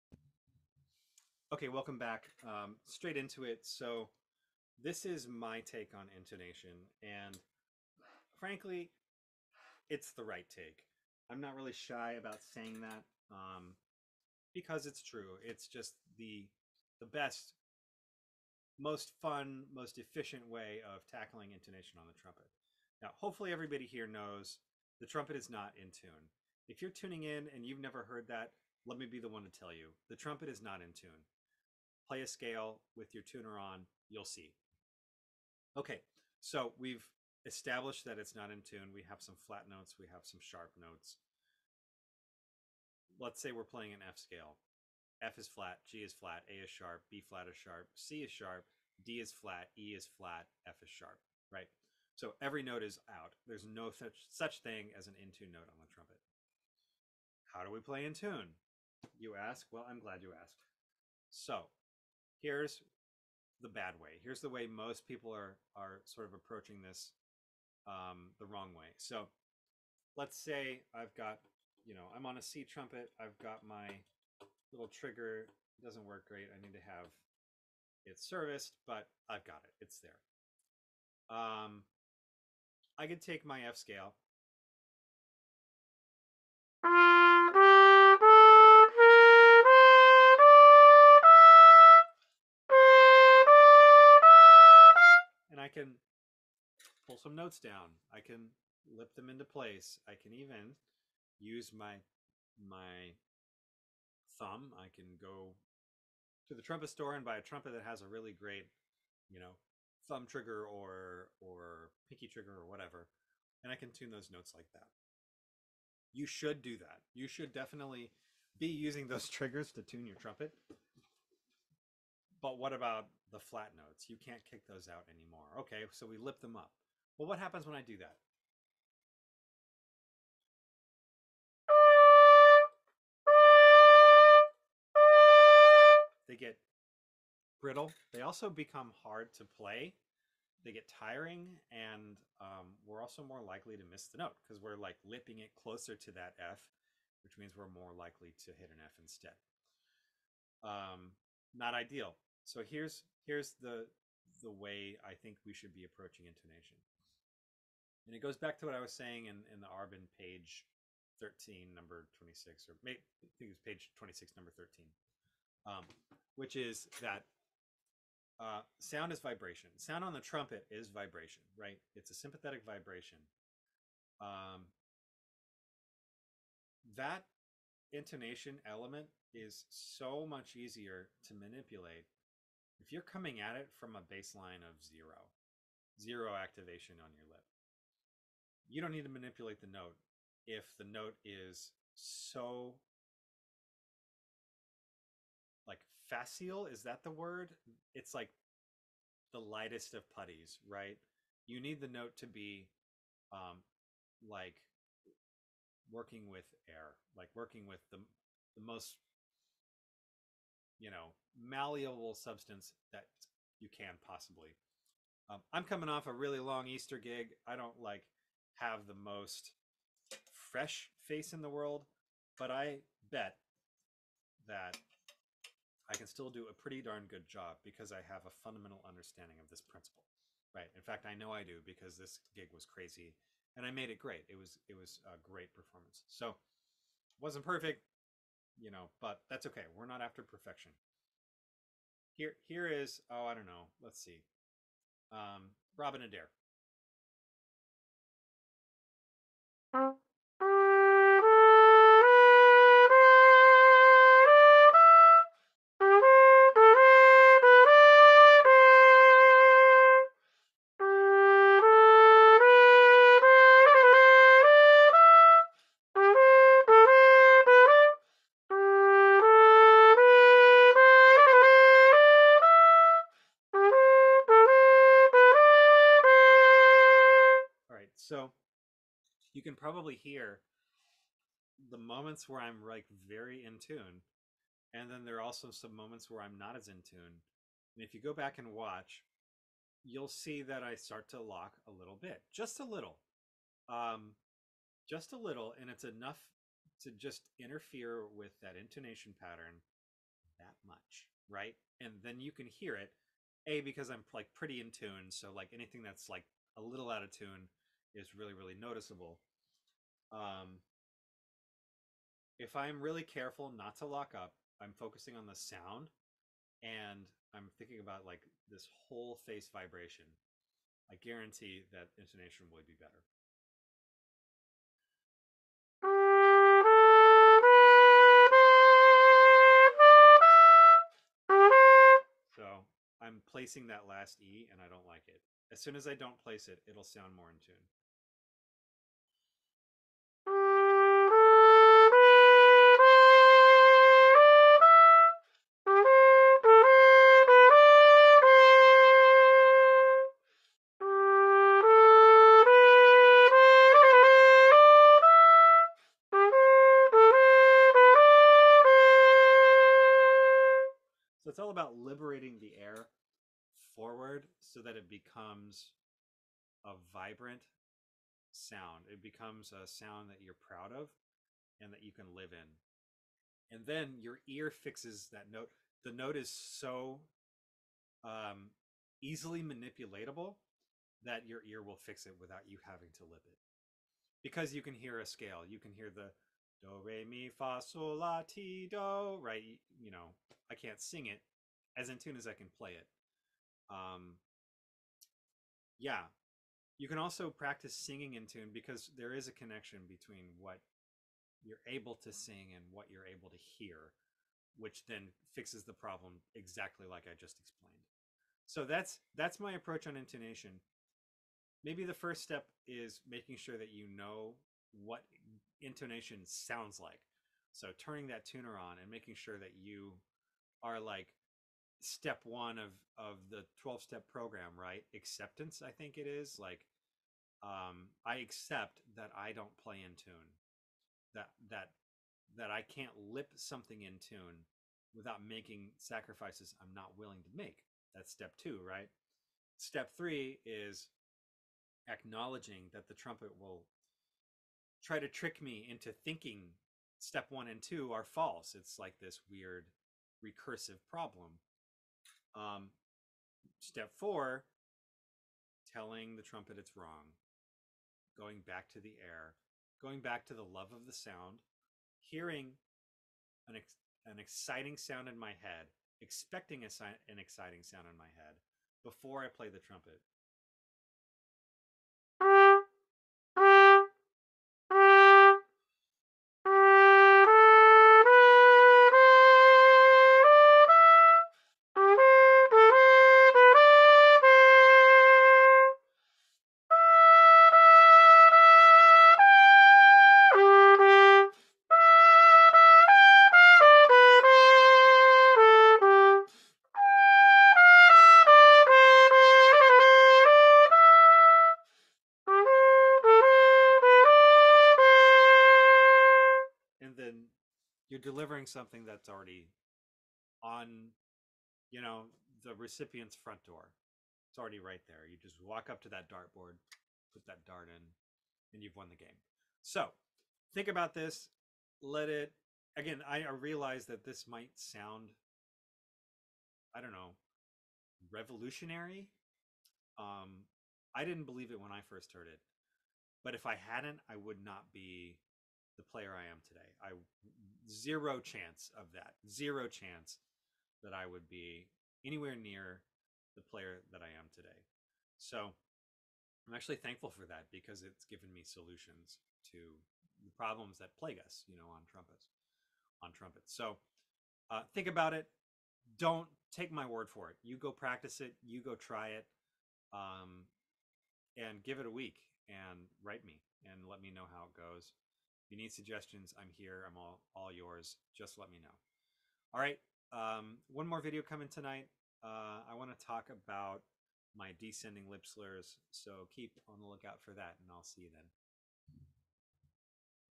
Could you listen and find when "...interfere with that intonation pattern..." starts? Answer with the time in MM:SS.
04:57.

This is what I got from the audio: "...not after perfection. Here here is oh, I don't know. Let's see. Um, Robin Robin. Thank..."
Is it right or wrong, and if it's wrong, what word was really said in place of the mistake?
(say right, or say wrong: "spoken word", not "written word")
wrong: "Adair", not "Robin".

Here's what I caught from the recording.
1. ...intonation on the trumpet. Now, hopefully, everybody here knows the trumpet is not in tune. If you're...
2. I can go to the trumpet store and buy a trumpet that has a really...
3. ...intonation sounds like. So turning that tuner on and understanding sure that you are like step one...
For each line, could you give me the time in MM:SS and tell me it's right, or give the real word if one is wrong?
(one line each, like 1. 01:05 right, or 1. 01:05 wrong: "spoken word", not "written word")
1. 00:21 right
2. 01:44 right
3. 06:55 wrong: "making", not "understanding".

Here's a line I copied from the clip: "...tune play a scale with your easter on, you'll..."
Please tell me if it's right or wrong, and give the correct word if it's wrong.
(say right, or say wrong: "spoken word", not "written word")
wrong: "tuner", not "easter".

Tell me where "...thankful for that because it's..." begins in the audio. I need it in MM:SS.
09:06.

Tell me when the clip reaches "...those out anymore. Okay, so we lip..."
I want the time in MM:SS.
02:04.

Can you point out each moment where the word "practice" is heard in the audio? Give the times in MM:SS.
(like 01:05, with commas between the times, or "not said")
06:37, 09:17.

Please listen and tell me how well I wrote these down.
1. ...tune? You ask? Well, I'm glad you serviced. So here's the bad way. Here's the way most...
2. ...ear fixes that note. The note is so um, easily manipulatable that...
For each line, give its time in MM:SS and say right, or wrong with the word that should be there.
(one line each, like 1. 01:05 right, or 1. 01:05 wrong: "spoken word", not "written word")
1. 00:58 wrong: "asked", not "serviced"
2. 06:14 right.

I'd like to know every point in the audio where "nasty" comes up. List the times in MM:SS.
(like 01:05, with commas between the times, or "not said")
not said.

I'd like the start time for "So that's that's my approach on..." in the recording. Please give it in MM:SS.
06:48.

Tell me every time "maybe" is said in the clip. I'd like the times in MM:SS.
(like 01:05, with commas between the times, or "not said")
02:42, 06:51.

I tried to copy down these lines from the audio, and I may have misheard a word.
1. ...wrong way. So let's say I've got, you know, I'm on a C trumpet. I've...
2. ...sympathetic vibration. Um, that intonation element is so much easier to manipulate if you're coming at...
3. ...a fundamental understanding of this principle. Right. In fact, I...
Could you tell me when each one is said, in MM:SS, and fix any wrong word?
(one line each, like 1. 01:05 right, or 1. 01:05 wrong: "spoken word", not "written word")
1. 01:08 right
2. 02:52 right
3. 03:48 right.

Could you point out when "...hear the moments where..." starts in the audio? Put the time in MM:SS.
04:39.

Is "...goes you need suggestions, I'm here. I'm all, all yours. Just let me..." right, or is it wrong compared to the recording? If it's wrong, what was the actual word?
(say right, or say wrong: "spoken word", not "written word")
right.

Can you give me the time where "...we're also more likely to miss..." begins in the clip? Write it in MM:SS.
02:22.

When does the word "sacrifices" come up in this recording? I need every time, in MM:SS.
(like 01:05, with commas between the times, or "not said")
07:15.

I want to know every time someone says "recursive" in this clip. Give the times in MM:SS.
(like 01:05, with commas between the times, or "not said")
07:30.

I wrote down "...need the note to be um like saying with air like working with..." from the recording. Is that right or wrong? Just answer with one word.
wrong.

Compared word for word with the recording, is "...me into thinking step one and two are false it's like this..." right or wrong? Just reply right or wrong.
right.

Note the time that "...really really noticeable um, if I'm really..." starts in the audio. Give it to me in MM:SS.
05:08.